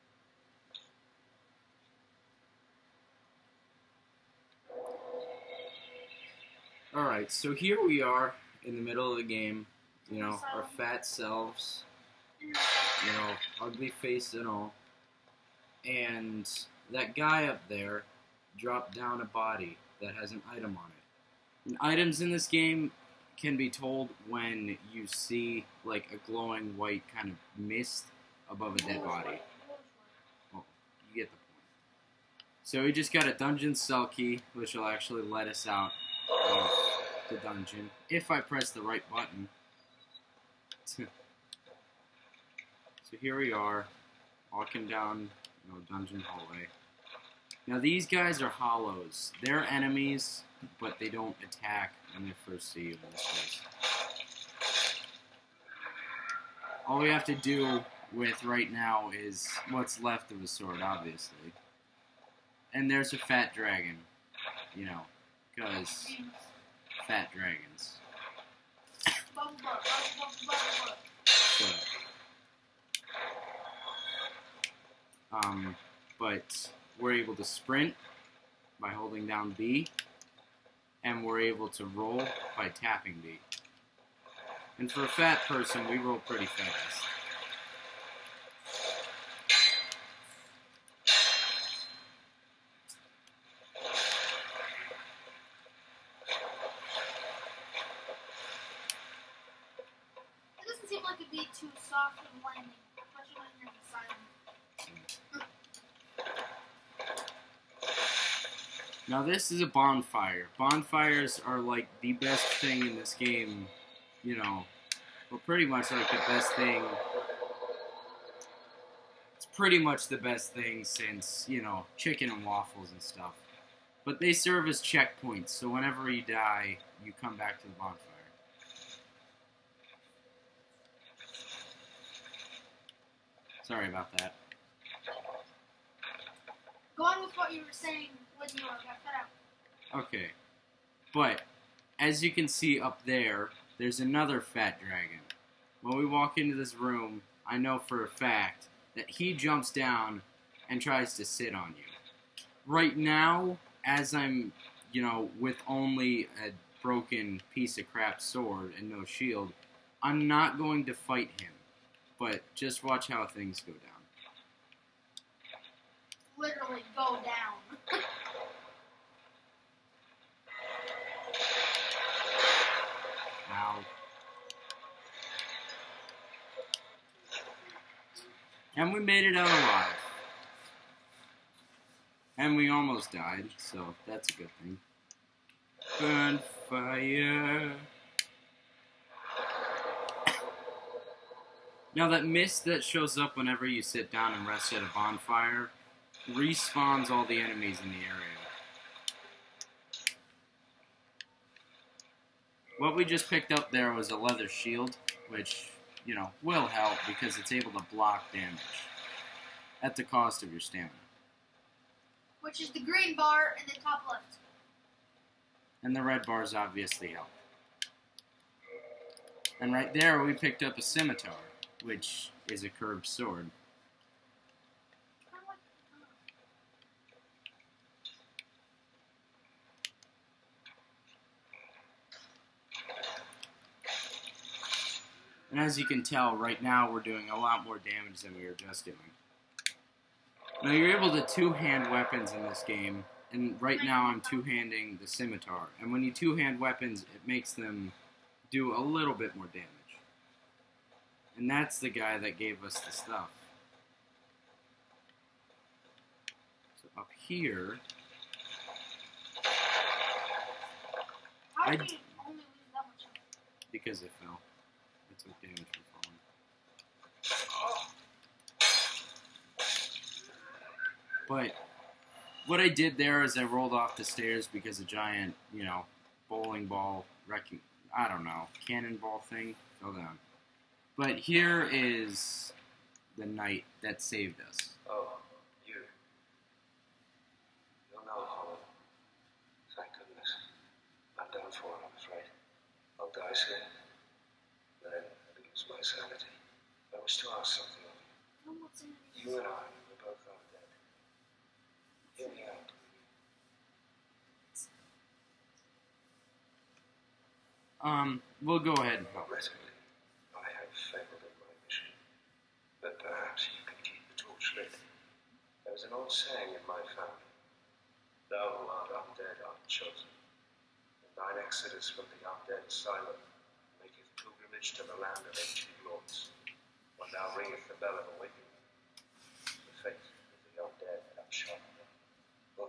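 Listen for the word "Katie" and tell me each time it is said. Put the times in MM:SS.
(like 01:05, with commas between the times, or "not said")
not said.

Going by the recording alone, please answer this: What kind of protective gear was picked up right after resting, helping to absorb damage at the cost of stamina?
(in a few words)
Leather shield.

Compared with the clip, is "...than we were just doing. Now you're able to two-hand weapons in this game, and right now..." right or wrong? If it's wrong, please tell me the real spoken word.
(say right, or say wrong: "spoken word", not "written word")
right.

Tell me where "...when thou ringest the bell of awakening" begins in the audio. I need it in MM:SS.
05:26.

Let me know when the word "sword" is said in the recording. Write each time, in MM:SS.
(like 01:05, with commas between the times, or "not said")
01:00, 02:38, 03:43.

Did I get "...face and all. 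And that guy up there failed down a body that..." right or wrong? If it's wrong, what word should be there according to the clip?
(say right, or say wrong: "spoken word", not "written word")
wrong: "dropped", not "failed".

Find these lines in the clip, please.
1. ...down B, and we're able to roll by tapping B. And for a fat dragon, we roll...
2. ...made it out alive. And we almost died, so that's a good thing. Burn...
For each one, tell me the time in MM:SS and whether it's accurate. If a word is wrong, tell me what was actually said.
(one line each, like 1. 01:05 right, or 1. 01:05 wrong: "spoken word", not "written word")
1. 01:19 wrong: "person", not "dragon"
2. 02:58 right.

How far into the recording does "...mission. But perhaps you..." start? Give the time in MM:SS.
05:11.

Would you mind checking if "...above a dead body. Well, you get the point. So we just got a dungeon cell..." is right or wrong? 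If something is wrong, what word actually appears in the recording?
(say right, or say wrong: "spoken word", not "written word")
right.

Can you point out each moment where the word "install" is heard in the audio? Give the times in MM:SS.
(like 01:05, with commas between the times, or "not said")
not said.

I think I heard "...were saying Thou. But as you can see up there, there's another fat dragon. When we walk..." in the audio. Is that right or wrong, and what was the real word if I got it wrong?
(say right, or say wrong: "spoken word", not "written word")
wrong: "Okay", not "Thou".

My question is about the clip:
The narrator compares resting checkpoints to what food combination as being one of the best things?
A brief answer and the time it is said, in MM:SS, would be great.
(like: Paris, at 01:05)
Chicken and waffles, at 02:01.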